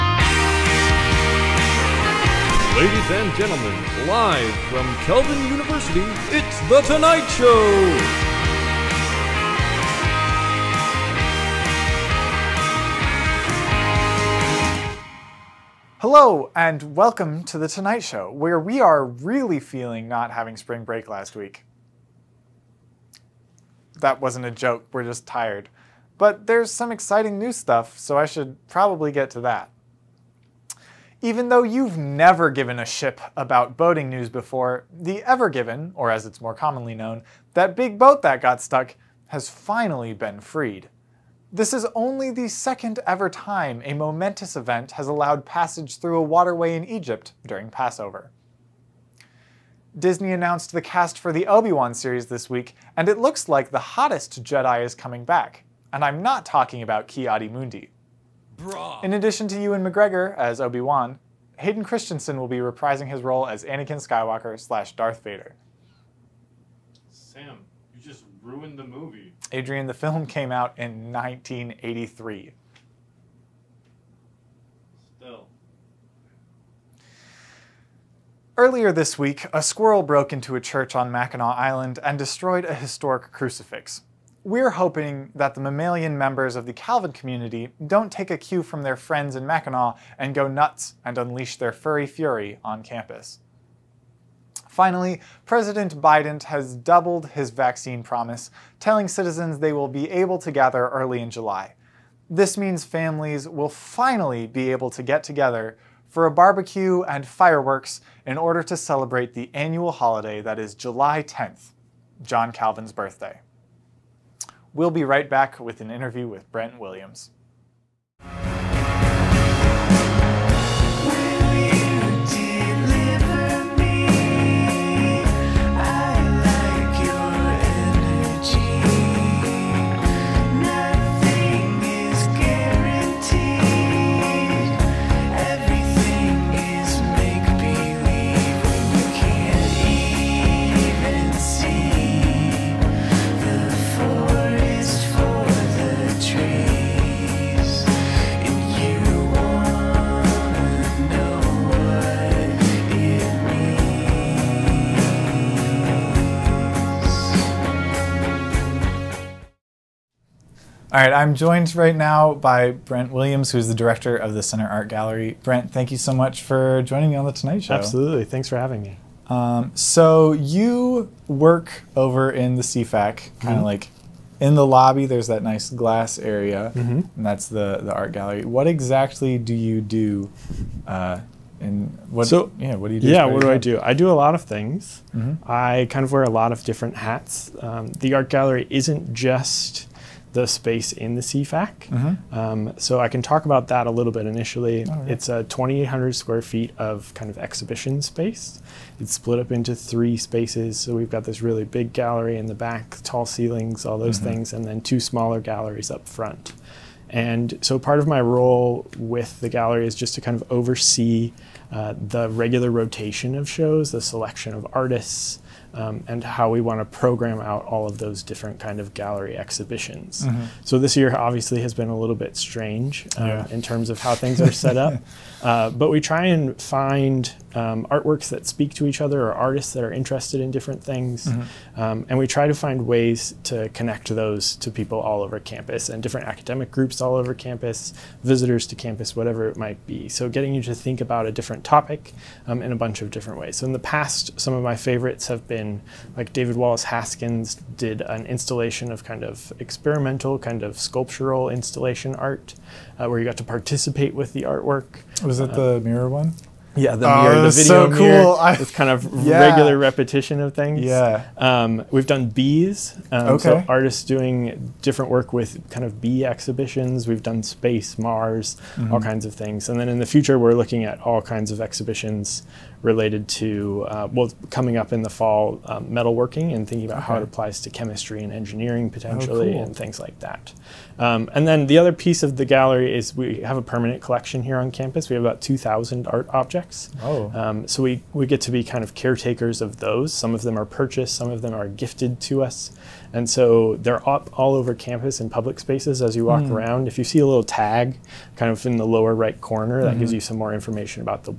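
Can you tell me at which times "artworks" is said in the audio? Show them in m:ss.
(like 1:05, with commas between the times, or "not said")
3:47, 4:14.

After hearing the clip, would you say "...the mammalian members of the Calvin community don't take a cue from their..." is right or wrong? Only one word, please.
right.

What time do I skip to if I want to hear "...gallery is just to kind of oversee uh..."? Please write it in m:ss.
3:29.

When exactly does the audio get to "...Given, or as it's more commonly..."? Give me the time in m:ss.
0:35.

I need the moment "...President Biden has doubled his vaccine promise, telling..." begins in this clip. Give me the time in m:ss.
1:35.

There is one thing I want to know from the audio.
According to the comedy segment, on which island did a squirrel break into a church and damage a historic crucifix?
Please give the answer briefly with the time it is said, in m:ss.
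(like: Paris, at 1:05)
Mackinac Island, at 1:21.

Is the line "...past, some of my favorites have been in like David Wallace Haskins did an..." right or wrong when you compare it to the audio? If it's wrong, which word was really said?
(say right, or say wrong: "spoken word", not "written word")
right.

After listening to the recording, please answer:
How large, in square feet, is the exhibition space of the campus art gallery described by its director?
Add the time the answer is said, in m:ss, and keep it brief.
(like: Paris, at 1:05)
2,800 square feet, at 3:15.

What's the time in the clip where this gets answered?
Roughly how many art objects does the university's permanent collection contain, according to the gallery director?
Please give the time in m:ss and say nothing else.
4:45.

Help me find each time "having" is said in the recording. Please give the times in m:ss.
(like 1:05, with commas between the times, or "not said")
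0:20, 2:48.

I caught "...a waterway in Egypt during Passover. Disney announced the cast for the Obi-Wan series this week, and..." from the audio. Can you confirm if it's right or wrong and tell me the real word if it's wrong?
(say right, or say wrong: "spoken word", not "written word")
right.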